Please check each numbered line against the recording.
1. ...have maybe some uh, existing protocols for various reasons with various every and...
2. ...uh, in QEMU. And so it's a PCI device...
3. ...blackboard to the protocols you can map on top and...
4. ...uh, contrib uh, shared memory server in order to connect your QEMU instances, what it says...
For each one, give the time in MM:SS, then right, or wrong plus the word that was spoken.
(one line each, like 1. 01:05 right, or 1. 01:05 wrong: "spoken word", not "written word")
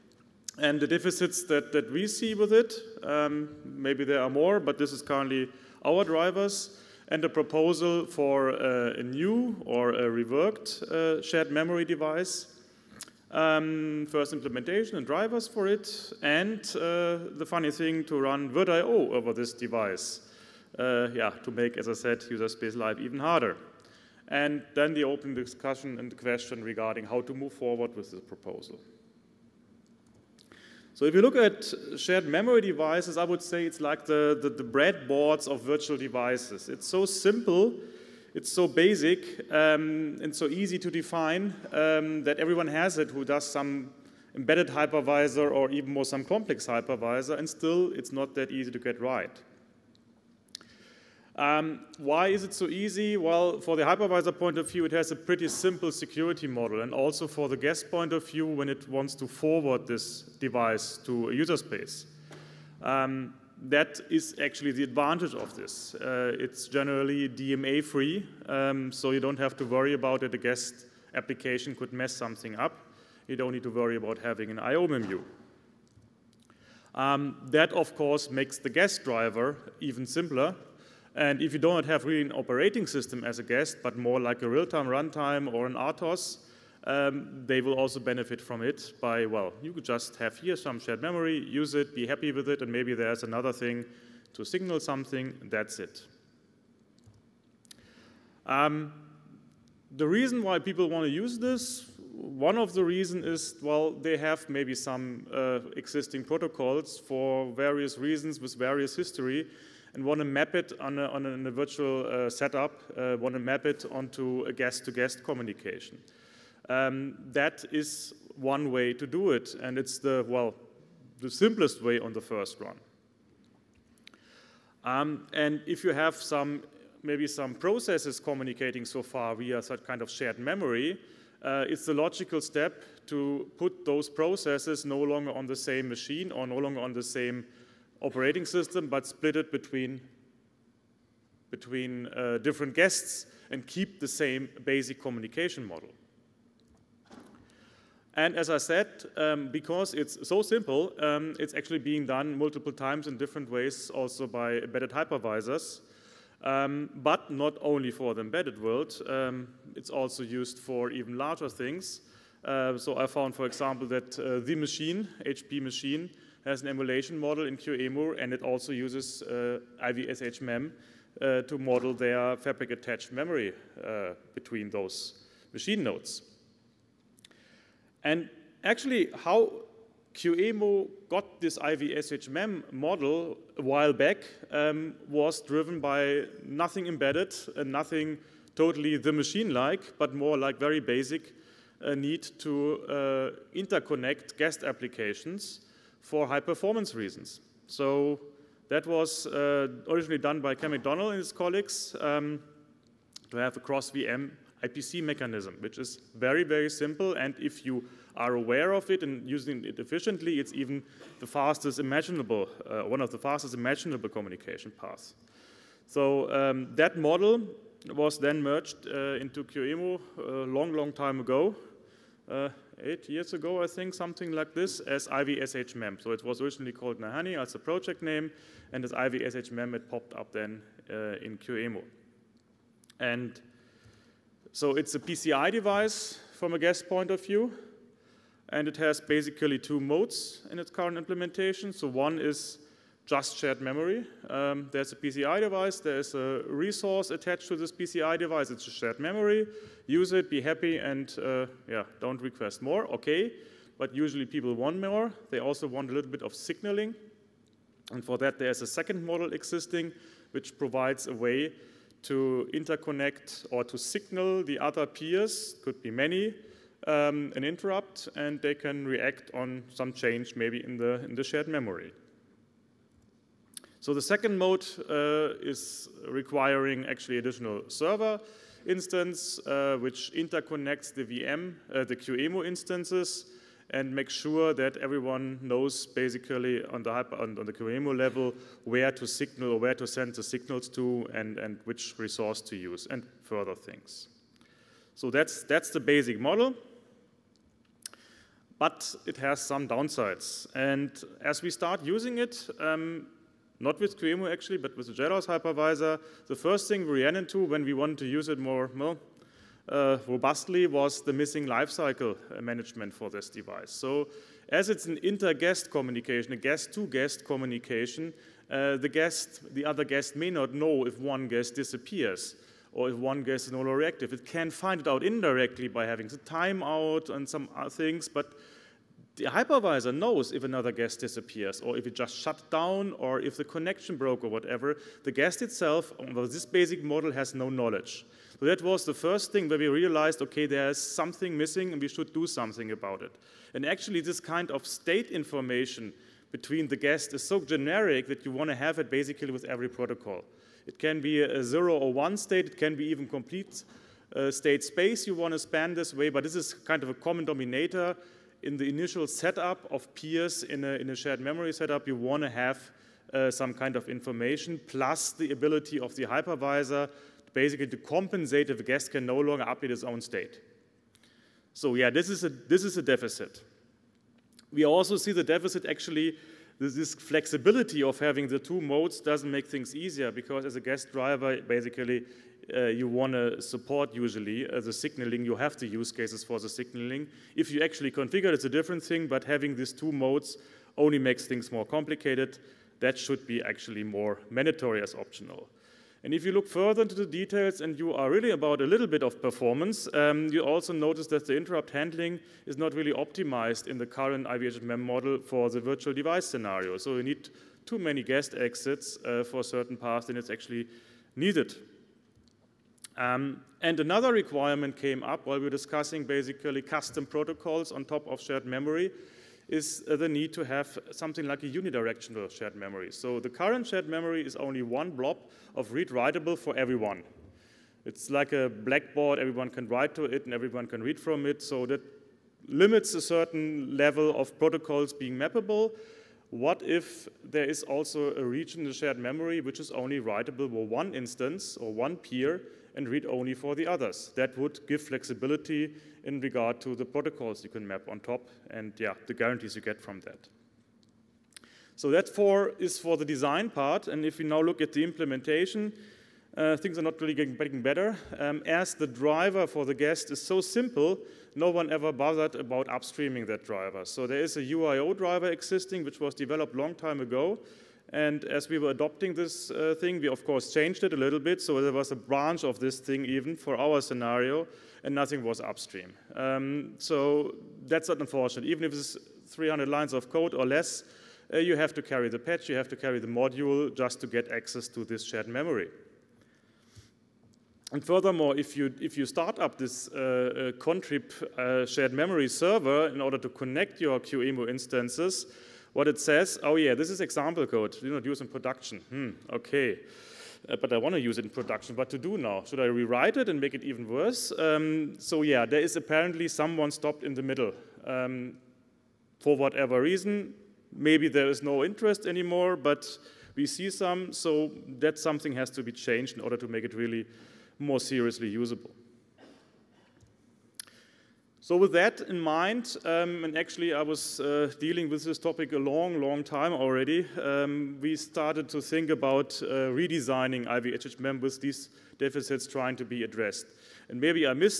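1. 01:44 wrong: "history", not "every"
2. 03:50 right
3. 07:26 wrong: "regard", not "blackboard"
4. 08:09 right.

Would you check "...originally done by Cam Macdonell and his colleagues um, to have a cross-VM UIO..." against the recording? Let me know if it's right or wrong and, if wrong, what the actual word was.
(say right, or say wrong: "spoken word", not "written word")
wrong: "IPC", not "UIO".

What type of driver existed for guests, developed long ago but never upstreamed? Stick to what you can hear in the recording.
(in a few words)
UIO driver.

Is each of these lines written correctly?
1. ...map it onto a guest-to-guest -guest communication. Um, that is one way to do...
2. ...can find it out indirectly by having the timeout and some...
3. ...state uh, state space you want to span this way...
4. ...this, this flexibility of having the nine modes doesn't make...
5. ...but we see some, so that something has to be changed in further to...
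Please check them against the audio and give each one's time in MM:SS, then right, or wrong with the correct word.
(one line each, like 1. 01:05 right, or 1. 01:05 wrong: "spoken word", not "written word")
1. 01:53 right
2. 05:24 right
3. 05:53 wrong: "complete", not "state"
4. 06:16 wrong: "two", not "nine"
5. 08:32 wrong: "order", not "further".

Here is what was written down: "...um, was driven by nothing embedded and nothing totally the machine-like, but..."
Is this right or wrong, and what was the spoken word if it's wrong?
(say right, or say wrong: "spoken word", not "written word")
right.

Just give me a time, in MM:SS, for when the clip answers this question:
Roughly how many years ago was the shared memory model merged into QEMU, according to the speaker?
03:42.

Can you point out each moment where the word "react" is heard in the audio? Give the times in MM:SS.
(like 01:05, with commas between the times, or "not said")
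04:28.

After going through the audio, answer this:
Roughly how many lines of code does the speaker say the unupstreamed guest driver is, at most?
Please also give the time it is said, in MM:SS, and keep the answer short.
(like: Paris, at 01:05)
300, at 07:59.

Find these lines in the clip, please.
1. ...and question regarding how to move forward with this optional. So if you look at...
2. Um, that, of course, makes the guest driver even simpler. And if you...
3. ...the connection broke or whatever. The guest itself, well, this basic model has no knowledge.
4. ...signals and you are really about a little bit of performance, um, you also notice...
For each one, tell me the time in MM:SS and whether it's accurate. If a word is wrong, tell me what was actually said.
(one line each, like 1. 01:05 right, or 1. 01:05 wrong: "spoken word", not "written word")
1. 00:25 wrong: "proposal", not "optional"
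2. 01:16 right
3. 05:33 right
4. 06:37 wrong: "details", not "signals".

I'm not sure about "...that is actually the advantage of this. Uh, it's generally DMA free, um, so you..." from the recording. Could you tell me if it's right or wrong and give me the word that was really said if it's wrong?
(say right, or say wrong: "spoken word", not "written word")
right.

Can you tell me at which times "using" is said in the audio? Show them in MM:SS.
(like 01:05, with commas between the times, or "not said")
03:29, 05:01.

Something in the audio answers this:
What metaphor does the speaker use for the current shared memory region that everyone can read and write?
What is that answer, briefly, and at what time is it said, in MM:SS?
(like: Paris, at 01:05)
A blackboard, at 07:08.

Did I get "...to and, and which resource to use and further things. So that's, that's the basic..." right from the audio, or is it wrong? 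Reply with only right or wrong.
right.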